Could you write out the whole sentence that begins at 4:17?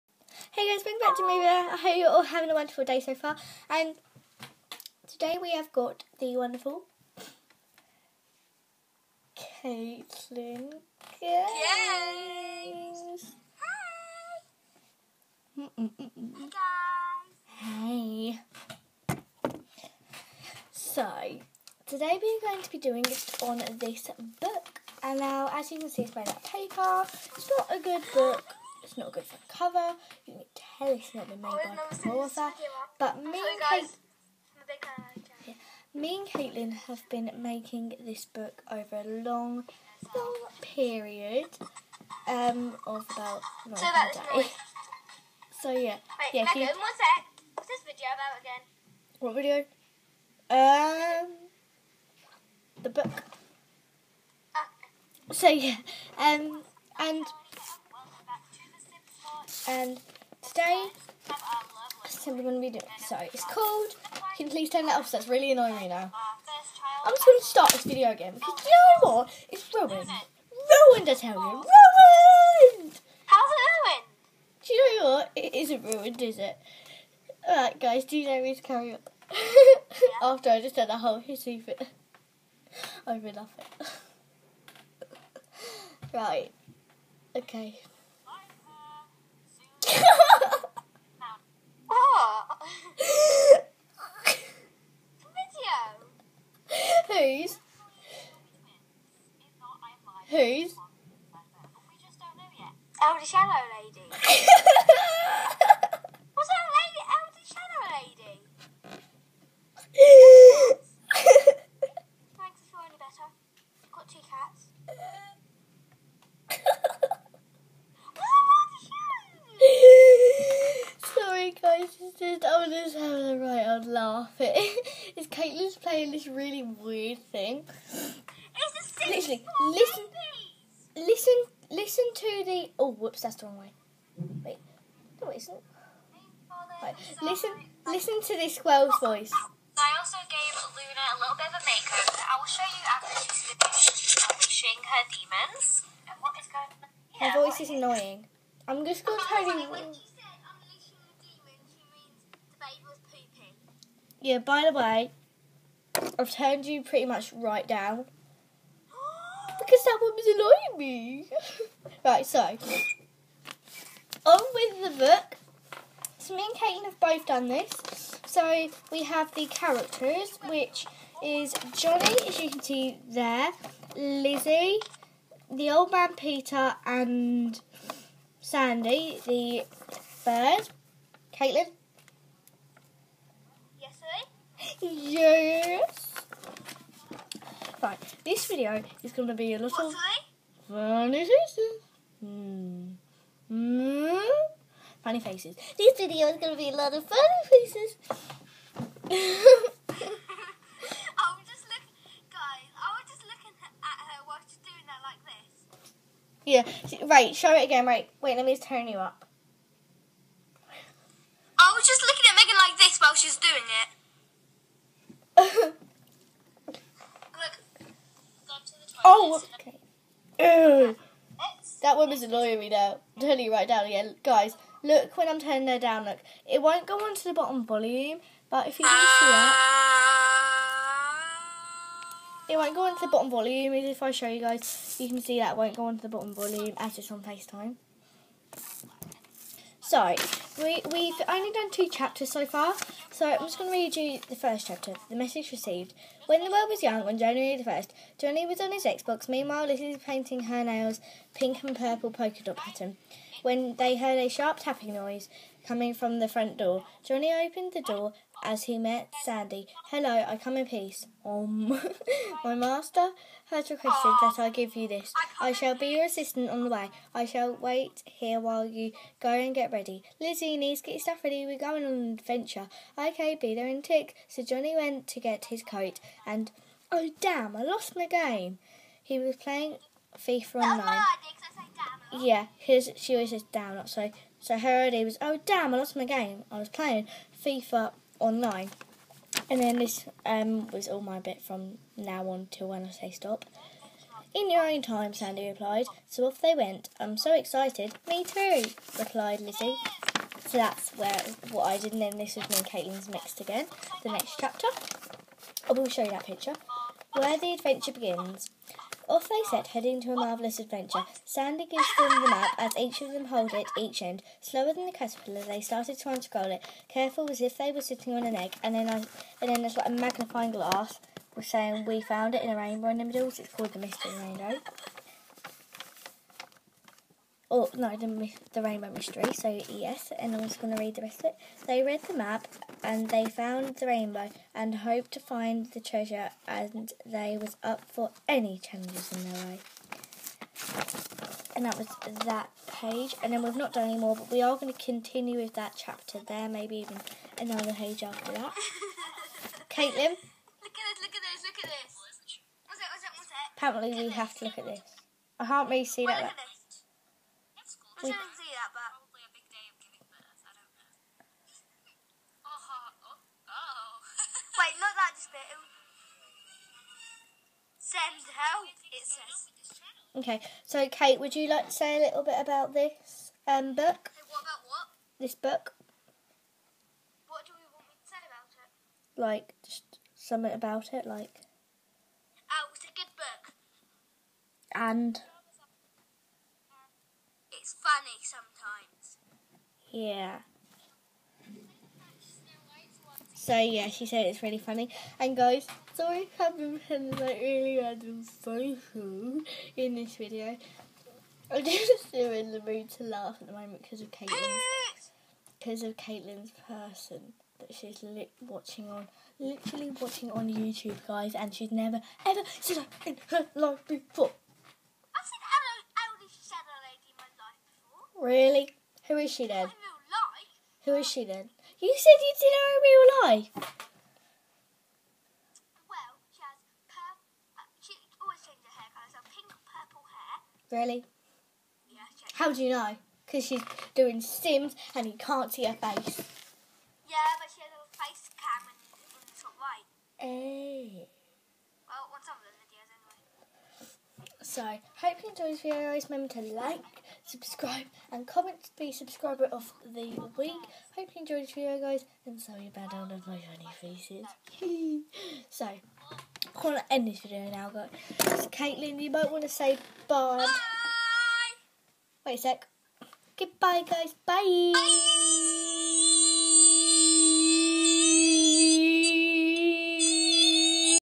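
Johnny opened the door as he met Sandy.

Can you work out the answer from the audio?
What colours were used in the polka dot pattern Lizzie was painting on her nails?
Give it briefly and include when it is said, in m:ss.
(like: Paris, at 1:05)
pink and purple, at 4:11.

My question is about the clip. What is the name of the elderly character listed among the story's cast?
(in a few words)
Peter.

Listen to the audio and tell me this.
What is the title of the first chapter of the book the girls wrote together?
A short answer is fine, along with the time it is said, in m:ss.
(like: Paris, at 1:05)
The Message Received, at 4:05.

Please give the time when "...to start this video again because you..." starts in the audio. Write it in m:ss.
1:07.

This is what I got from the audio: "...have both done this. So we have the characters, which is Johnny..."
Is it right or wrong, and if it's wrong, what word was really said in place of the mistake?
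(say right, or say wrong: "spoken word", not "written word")
right.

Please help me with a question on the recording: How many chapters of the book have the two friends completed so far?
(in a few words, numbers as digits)
2.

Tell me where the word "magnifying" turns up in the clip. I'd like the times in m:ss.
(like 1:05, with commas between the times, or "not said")
5:19.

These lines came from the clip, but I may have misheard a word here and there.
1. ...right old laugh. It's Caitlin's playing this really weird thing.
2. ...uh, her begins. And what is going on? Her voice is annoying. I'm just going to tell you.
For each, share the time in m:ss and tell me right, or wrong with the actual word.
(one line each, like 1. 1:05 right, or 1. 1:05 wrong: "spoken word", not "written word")
1. 2:03 right
2. 2:24 wrong: "demons", not "begins".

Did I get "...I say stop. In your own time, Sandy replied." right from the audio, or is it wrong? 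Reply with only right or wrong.
right.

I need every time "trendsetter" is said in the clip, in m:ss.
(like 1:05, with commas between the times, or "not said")
not said.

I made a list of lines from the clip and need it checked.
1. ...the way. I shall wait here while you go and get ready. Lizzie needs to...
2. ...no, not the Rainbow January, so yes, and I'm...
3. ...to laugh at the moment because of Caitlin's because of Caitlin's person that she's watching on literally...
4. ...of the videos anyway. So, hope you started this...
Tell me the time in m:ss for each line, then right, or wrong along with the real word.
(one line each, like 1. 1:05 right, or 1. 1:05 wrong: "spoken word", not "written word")
1. 4:26 right
2. 5:27 wrong: "Mystery", not "January"
3. 6:42 right
4. 7:23 wrong: "enjoyed", not "started".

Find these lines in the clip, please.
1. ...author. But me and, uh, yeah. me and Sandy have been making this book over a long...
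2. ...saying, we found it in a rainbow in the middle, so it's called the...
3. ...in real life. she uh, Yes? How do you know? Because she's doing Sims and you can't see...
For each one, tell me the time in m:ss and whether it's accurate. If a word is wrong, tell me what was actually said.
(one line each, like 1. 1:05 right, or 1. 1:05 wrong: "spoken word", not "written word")
1. 0:32 wrong: "Caitlin", not "Sandy"
2. 5:21 right
3. 7:02 wrong: "Really", not "Yes".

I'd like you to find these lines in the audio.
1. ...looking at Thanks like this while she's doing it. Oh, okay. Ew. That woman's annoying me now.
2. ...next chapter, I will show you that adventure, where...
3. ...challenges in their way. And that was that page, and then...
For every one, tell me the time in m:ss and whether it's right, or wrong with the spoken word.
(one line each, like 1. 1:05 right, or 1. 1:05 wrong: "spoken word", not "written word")
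1. 3:32 wrong: "Megan", not "Thanks"
2. 5:04 wrong: "picture", not "adventure"
3. 5:38 right.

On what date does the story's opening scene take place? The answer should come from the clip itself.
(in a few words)
January 1st.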